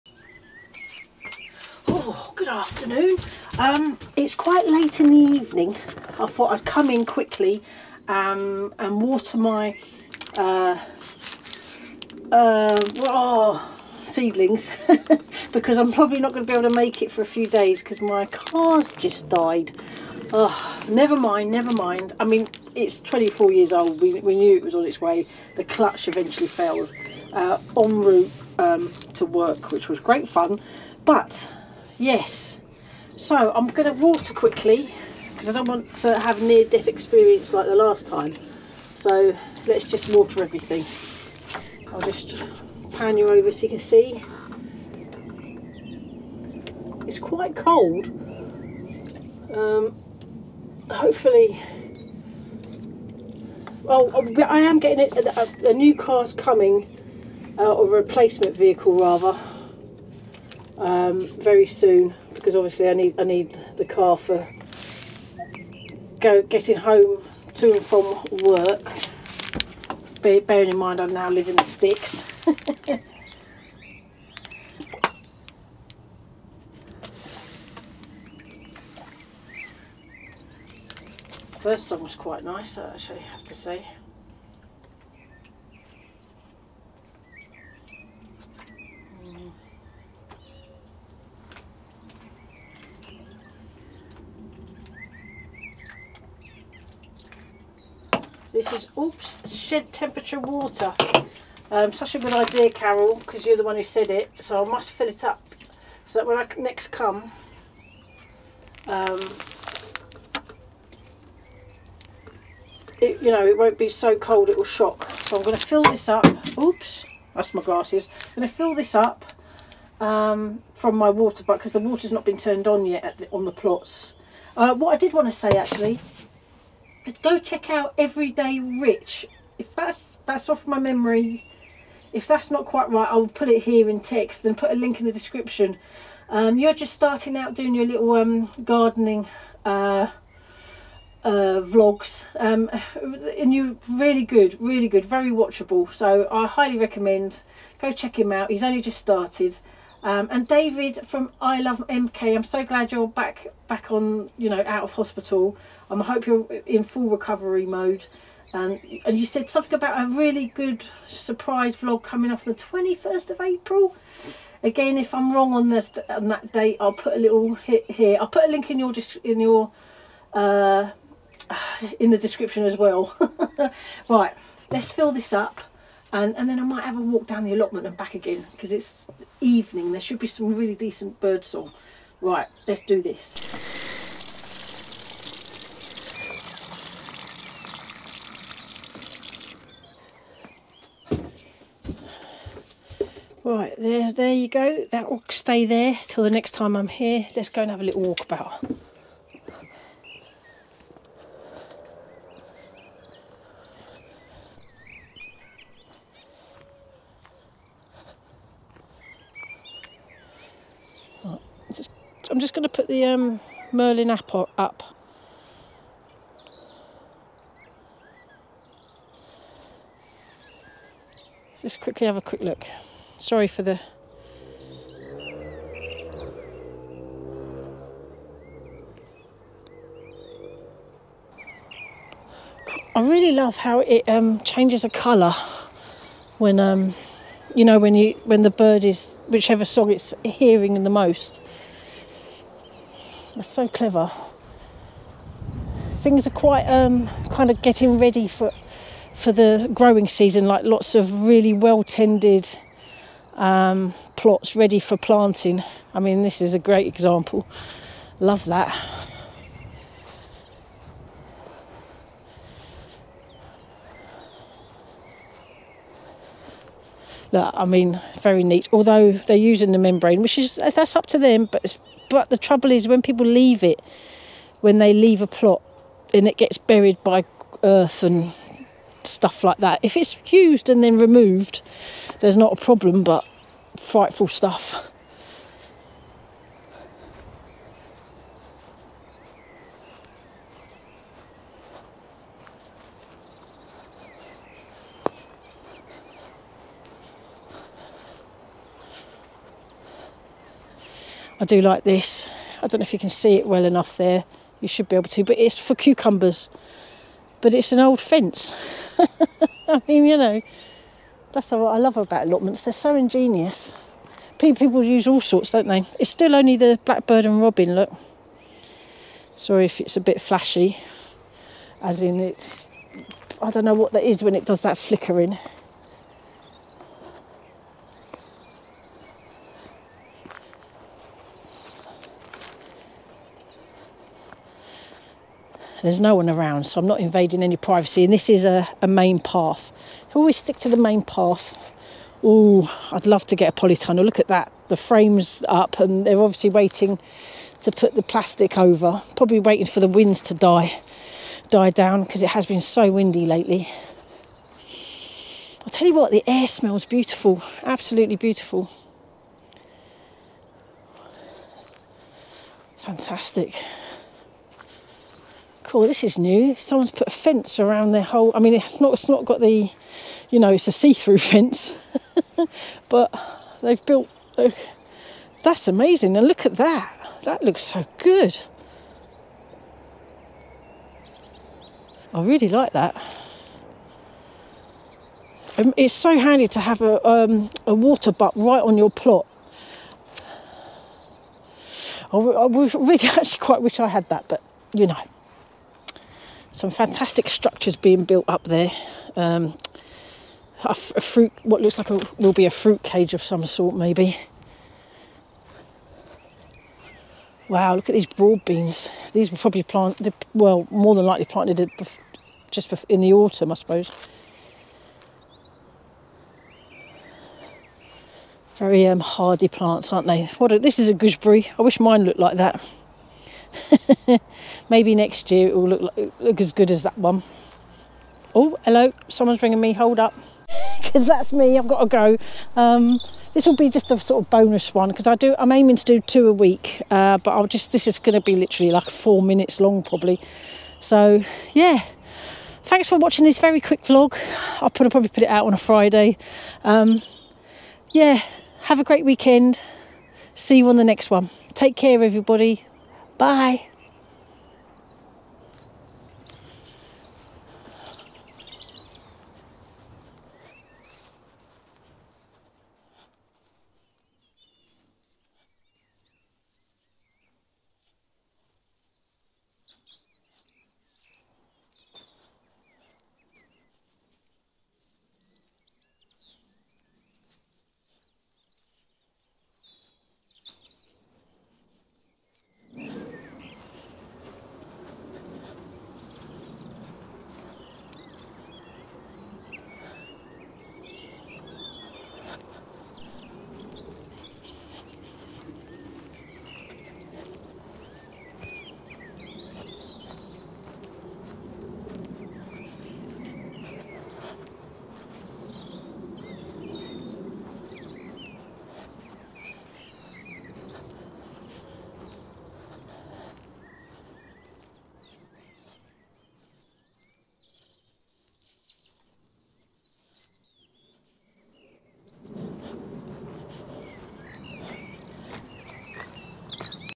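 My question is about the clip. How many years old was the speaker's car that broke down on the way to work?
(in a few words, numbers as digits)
24.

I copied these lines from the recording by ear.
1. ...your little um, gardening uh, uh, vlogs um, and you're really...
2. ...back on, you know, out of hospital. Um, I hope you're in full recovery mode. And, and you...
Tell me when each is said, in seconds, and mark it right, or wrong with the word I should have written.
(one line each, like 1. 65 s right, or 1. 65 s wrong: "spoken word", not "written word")
1. 137 s right
2. 153 s right.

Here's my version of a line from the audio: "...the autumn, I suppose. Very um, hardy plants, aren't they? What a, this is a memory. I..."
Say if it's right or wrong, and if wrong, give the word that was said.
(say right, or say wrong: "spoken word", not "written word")
wrong: "gooseberry", not "memory".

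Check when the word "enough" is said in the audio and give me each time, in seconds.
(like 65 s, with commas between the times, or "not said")
303 s.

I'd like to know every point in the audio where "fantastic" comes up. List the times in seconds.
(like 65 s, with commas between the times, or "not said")
362 s, 396 s.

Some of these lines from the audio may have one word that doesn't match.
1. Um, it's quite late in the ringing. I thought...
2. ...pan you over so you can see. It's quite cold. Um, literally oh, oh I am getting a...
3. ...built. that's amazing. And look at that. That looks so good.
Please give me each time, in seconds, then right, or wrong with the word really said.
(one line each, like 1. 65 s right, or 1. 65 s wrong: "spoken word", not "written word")
1. 3 s wrong: "evening", not "ringing"
2. 42 s wrong: "hopefully", not "literally"
3. 373 s right.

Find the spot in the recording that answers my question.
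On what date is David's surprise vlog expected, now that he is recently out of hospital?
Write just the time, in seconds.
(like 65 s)
162 s.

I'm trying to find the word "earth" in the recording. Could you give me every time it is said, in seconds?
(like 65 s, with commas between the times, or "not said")
277 s.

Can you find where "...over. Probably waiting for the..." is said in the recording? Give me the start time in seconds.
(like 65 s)
348 s.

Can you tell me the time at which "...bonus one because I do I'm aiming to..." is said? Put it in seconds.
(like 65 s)
434 s.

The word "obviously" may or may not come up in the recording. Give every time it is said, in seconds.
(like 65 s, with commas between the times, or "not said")
62 s, 346 s.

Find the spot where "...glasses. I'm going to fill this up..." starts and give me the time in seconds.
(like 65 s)
117 s.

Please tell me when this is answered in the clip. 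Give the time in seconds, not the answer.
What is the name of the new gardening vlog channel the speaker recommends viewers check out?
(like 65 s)
127 s.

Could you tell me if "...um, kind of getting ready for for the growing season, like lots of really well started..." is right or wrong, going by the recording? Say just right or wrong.
wrong.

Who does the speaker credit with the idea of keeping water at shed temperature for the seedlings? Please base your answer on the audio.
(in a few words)
Carol.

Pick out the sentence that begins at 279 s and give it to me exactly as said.
If it's used and then removed, there's not a problem, but frightful stuff.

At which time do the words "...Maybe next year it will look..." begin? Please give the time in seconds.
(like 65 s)
424 s.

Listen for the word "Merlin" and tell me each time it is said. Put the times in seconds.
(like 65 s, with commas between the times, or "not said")
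213 s.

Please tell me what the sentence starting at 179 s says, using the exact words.
There should be some really decent birdsong.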